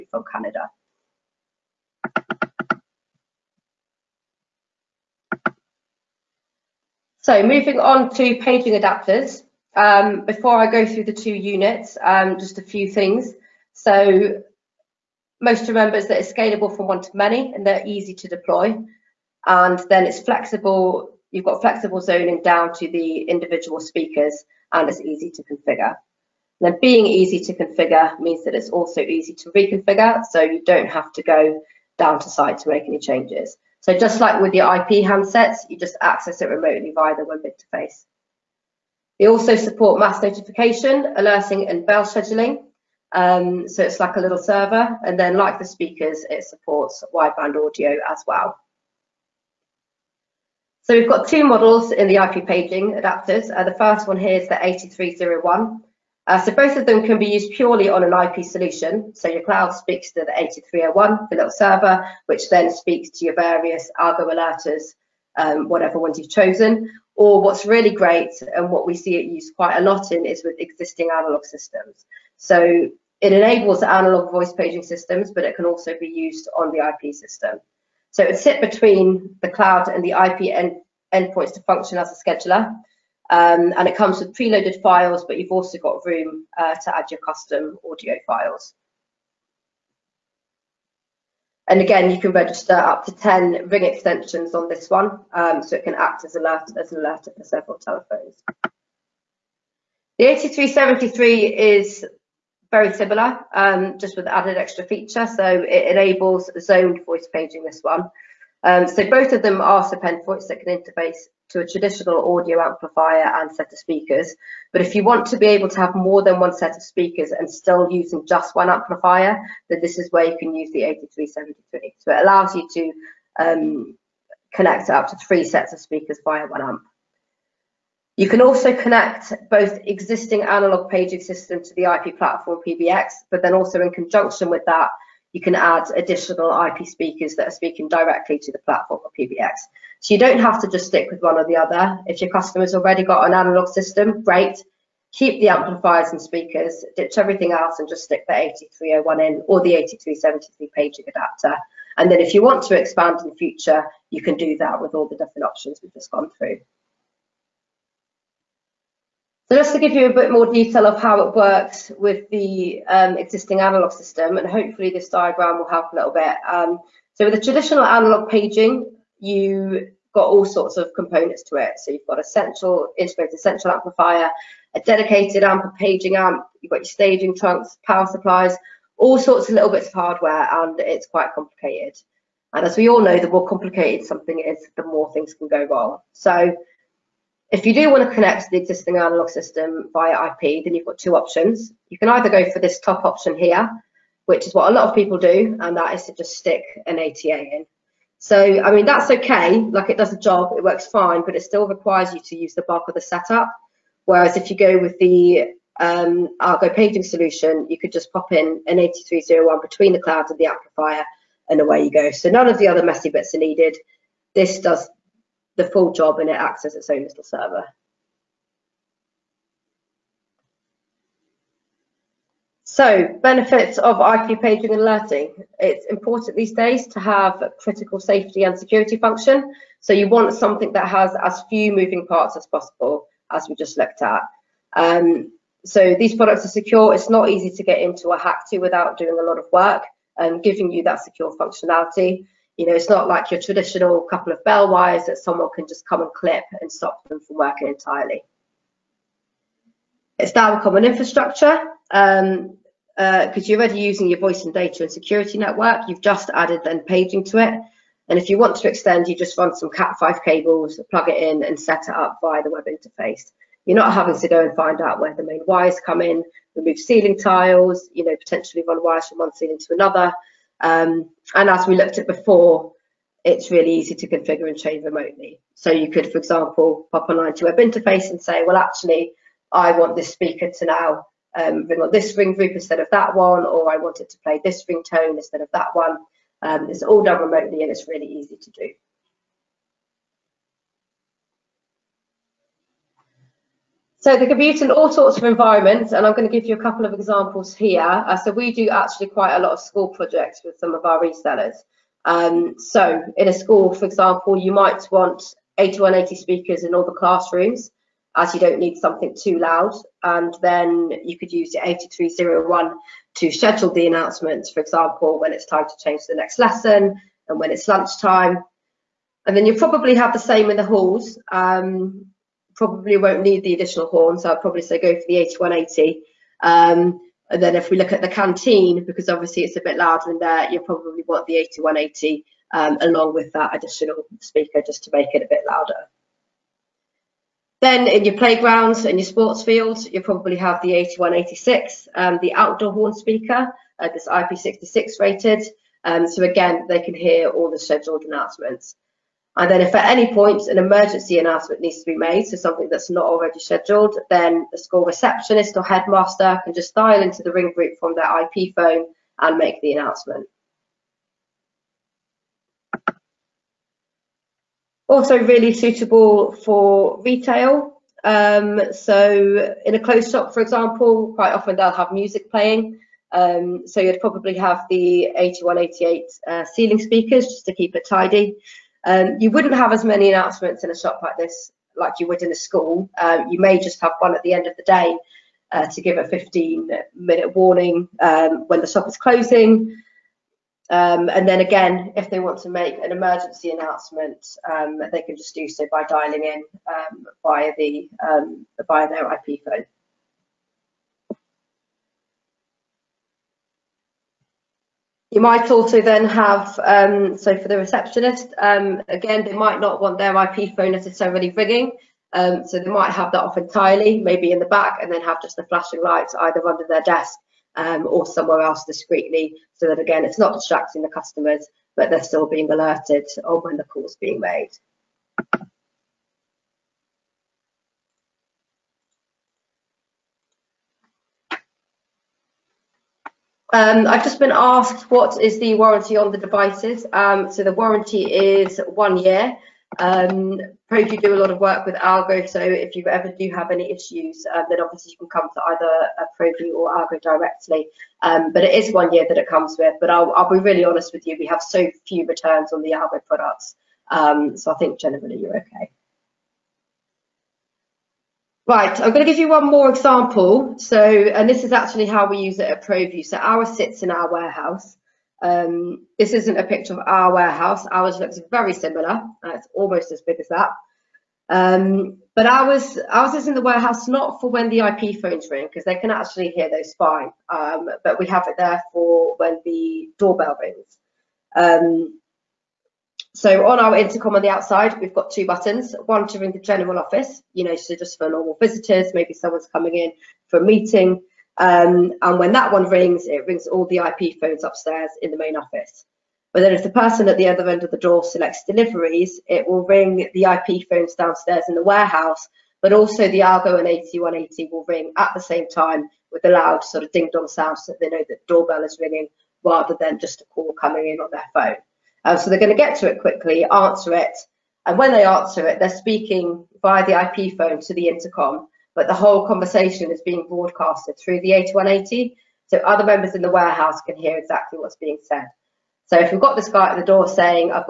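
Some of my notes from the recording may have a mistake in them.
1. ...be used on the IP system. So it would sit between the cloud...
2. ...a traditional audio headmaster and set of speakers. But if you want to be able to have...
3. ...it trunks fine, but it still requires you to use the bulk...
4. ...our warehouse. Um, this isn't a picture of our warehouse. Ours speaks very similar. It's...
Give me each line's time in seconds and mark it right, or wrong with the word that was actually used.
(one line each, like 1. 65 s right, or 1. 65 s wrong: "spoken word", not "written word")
1. 75 s right
2. 111 s wrong: "amplifier", not "headmaster"
3. 200 s wrong: "works", not "trunks"
4. 463 s wrong: "looks", not "speaks".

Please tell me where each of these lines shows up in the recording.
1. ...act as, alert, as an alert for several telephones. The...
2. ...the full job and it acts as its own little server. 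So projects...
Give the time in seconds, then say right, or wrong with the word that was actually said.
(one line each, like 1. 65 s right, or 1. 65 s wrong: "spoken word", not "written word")
1. 95 s right
2. 215 s wrong: "benefits", not "projects".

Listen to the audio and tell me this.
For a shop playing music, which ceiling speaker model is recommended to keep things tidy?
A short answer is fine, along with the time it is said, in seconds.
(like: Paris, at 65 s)
8188, at 375 s.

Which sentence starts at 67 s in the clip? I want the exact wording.
Or what's really great and what we see it used quite a lot in is with existing analog systems.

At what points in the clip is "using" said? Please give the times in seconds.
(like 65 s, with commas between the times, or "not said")
117 s, 253 s.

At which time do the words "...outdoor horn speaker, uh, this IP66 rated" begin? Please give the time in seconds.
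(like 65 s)
342 s.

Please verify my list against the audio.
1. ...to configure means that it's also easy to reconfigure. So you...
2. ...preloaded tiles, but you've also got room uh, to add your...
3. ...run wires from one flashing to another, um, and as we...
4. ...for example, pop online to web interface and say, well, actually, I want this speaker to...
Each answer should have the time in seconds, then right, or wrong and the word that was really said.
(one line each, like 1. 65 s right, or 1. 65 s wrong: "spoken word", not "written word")
1. 27 s right
2. 84 s wrong: "files", not "tiles"
3. 268 s wrong: "ceiling", not "flashing"
4. 276 s right.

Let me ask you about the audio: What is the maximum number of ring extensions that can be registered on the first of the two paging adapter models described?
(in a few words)
10.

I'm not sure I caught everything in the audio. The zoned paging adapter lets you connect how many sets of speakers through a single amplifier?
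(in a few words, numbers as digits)
3.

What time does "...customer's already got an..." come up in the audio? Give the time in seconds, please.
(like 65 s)
142 s.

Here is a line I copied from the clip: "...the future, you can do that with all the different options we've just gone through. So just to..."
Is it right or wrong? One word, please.
right.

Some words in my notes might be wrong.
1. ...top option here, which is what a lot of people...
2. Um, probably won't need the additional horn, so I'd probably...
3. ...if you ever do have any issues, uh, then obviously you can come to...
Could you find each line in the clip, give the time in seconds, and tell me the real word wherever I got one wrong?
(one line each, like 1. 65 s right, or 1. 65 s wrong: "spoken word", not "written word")
1. 192 s right
2. 321 s right
3. 442 s right.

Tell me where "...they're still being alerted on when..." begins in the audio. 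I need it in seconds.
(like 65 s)
421 s.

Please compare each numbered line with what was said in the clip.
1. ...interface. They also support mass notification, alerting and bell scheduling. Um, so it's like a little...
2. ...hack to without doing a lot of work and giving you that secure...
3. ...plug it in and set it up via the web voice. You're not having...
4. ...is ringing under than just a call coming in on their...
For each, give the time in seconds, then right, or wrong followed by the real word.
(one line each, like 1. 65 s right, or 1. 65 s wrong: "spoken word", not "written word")
1. 37 s right
2. 238 s right
3. 260 s wrong: "interface", not "voice"
4. 508 s wrong: "rather", not "under".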